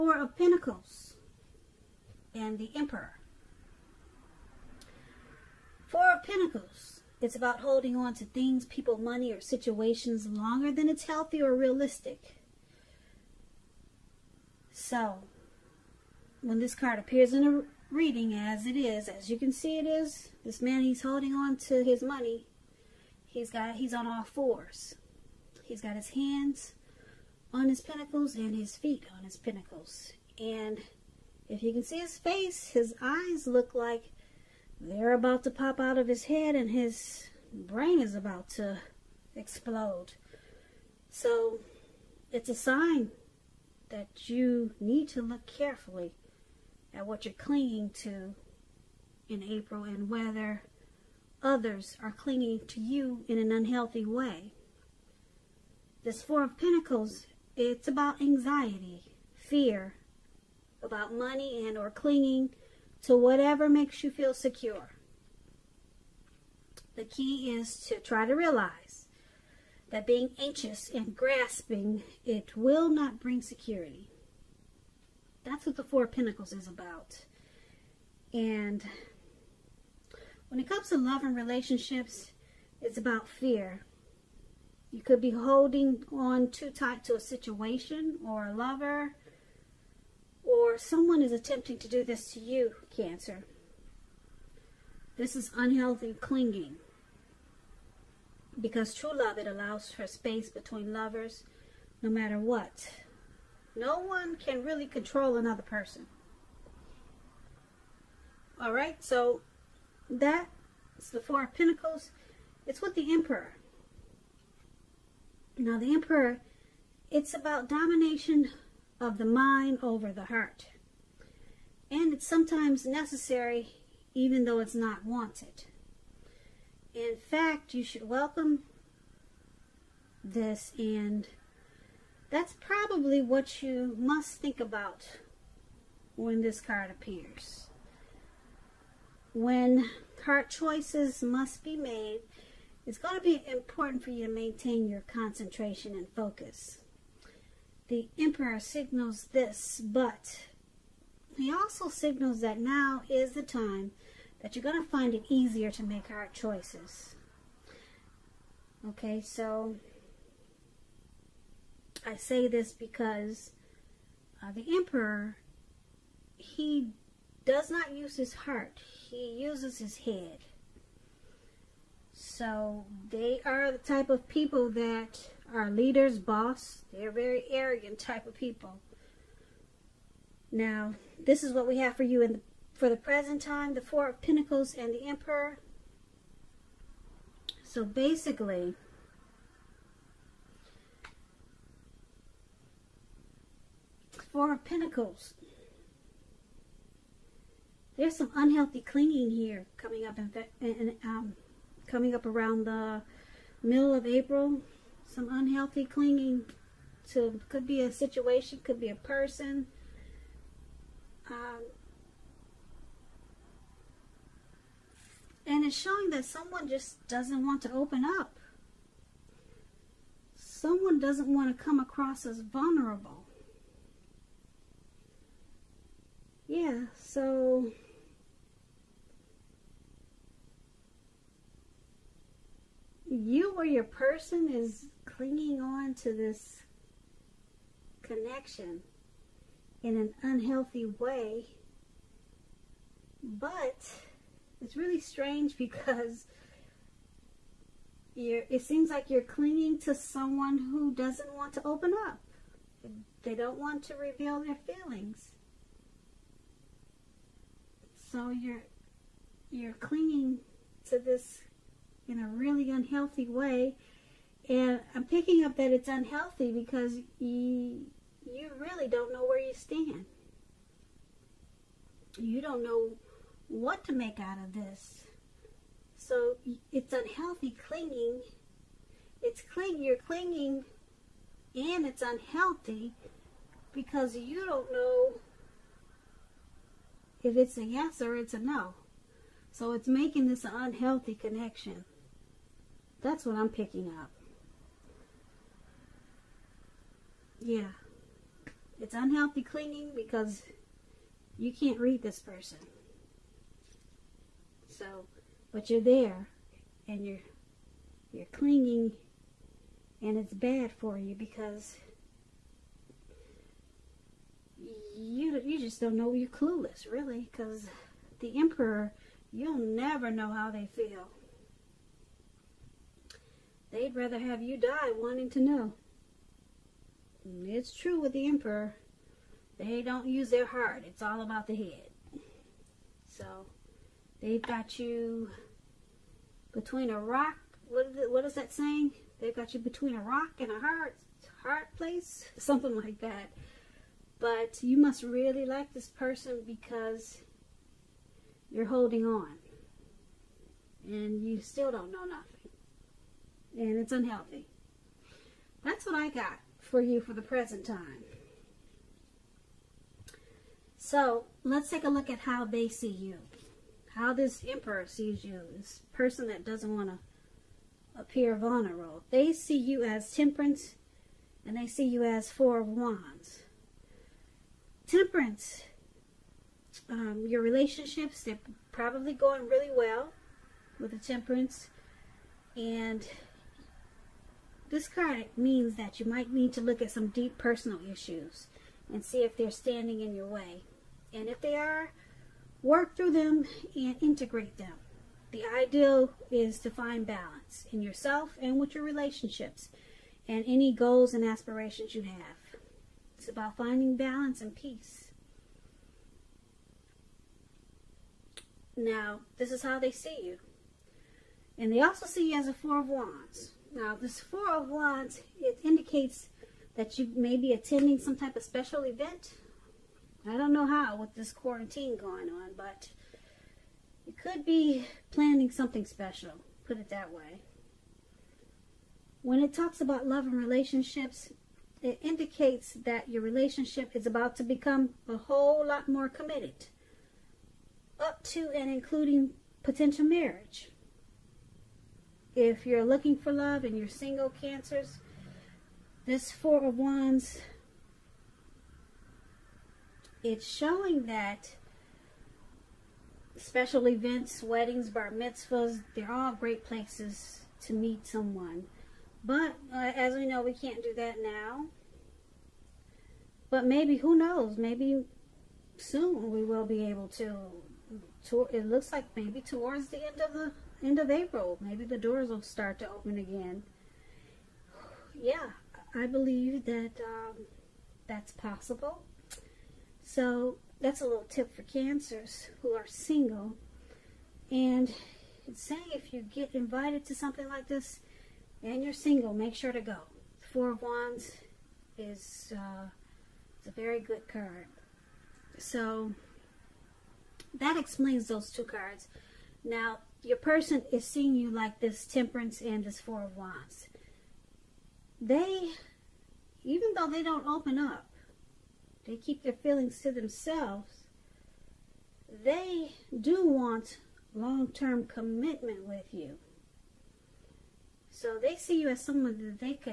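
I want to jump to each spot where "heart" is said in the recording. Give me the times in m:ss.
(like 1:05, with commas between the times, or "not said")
2:00, 2:20, 2:48, 5:30.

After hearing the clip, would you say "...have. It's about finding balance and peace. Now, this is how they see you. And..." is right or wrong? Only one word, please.
right.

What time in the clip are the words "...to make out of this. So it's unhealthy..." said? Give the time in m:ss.
4:33.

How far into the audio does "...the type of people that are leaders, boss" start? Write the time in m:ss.
2:53.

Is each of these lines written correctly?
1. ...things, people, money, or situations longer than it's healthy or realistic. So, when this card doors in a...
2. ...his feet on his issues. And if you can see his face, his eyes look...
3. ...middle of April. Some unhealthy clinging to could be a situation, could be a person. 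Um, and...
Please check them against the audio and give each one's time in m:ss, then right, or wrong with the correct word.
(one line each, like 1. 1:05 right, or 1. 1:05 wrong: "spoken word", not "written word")
1. 0:08 wrong: "appears", not "doors"
2. 0:28 wrong: "pentacles", not "issues"
3. 3:23 right.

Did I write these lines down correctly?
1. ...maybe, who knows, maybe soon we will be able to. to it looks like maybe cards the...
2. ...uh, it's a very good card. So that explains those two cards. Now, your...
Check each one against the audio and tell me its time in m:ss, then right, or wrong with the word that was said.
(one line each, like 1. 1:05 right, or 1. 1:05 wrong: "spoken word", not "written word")
1. 7:43 wrong: "towards", not "cards"
2. 8:12 right.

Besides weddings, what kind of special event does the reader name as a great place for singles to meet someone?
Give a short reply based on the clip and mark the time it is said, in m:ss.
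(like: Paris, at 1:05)
bar mitzvahs, at 7:34.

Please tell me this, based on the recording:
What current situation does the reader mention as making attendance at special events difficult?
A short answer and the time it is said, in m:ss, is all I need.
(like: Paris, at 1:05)
quarantine, at 7:01.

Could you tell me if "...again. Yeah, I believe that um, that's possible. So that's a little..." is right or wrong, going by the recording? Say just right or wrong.
right.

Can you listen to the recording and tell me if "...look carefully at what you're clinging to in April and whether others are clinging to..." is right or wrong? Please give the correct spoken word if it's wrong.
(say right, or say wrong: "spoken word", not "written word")
right.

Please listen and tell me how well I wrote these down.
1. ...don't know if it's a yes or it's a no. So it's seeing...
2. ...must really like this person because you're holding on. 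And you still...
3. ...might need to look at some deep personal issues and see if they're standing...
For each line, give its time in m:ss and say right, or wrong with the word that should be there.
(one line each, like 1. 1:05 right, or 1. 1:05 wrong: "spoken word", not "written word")
1. 4:44 wrong: "making", not "seeing"
2. 5:44 right
3. 6:26 right.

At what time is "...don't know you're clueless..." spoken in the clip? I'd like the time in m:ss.
5:15.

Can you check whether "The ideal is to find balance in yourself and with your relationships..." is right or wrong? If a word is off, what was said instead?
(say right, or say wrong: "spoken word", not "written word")
right.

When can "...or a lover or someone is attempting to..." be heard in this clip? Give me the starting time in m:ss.
1:28.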